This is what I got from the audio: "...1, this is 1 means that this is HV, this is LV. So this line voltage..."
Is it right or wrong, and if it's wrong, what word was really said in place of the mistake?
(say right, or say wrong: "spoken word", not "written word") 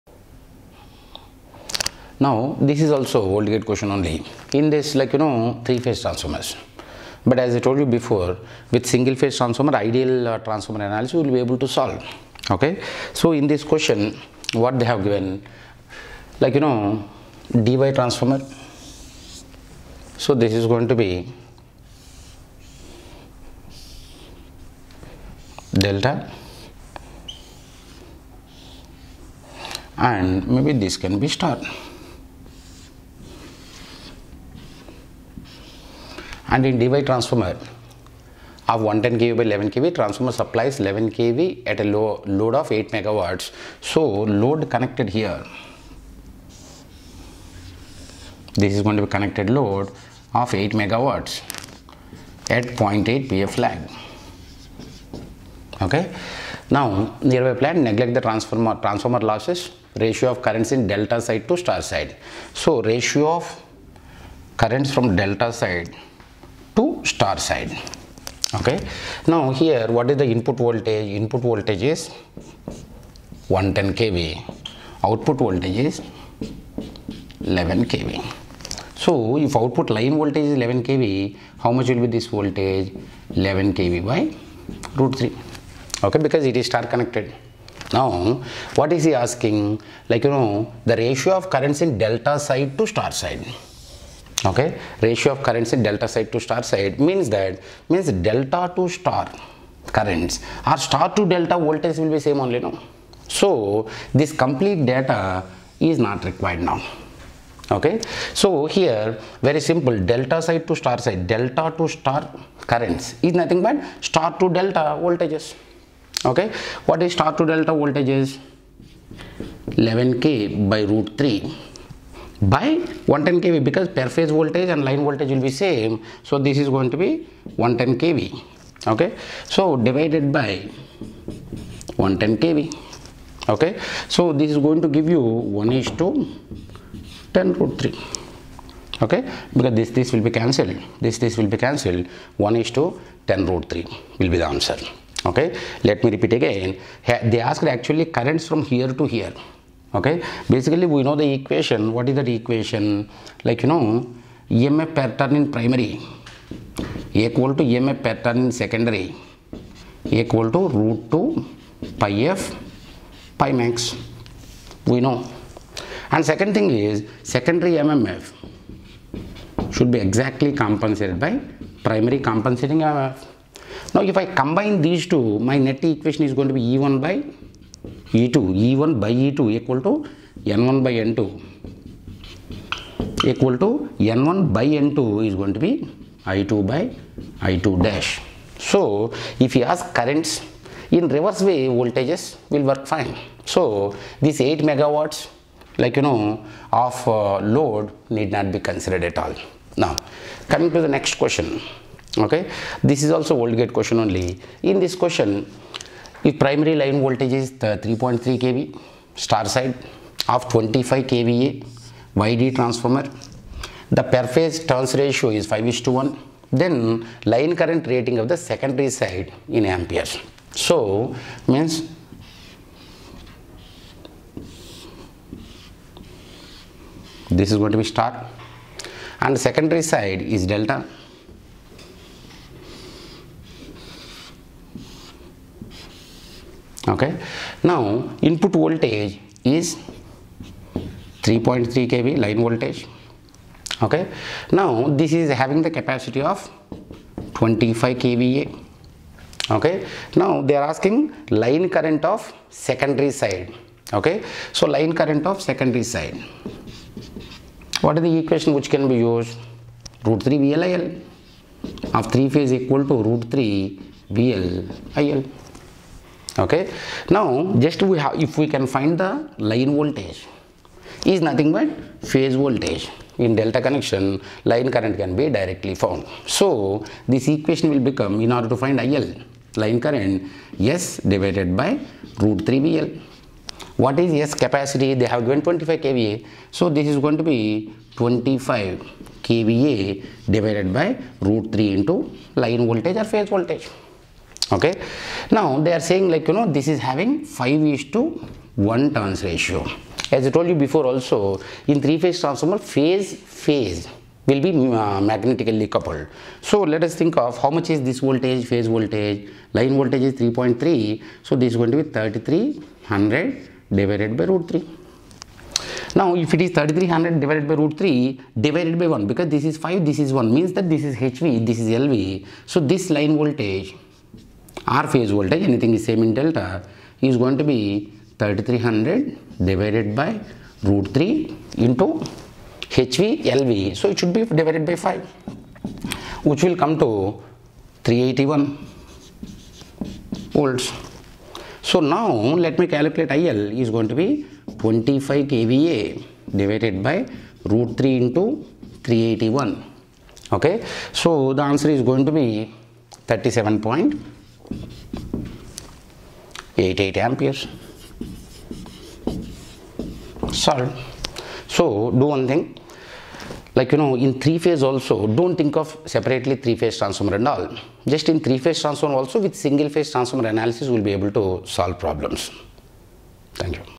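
wrong: "5", not "1".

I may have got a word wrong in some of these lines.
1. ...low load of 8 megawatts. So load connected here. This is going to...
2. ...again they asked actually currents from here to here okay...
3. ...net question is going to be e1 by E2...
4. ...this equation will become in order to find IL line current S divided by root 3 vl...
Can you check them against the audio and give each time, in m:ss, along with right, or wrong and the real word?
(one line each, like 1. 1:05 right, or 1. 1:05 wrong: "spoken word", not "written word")
1. 0:41 right
2. 2:26 right
3. 2:55 wrong: "equation", not "question"
4. 4:37 right.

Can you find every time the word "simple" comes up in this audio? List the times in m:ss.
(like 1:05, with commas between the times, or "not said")
1:49.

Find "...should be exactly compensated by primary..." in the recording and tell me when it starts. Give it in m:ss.
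2:49.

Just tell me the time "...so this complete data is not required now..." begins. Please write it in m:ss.
1:43.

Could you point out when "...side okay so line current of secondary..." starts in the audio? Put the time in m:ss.
4:13.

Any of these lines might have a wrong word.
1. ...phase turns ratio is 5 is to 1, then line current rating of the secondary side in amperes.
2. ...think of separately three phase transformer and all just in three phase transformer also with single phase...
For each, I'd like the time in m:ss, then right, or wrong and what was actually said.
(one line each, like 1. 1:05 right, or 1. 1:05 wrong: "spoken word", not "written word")
1. 3:34 right
2. 6:05 right.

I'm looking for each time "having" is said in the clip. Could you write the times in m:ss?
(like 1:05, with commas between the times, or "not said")
4:05, 4:56.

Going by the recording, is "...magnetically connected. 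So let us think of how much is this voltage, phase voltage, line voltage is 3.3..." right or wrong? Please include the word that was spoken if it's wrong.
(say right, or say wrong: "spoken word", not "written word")
wrong: "coupled", not "connected".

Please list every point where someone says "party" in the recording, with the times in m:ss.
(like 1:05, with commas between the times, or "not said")
not said.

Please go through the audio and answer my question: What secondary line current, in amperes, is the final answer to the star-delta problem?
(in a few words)
37.88.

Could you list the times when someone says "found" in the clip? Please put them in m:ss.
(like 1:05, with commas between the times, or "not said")
4:35.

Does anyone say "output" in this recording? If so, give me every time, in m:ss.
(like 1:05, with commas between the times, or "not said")
1:15, 1:19.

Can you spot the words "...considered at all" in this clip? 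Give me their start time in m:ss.
3:18.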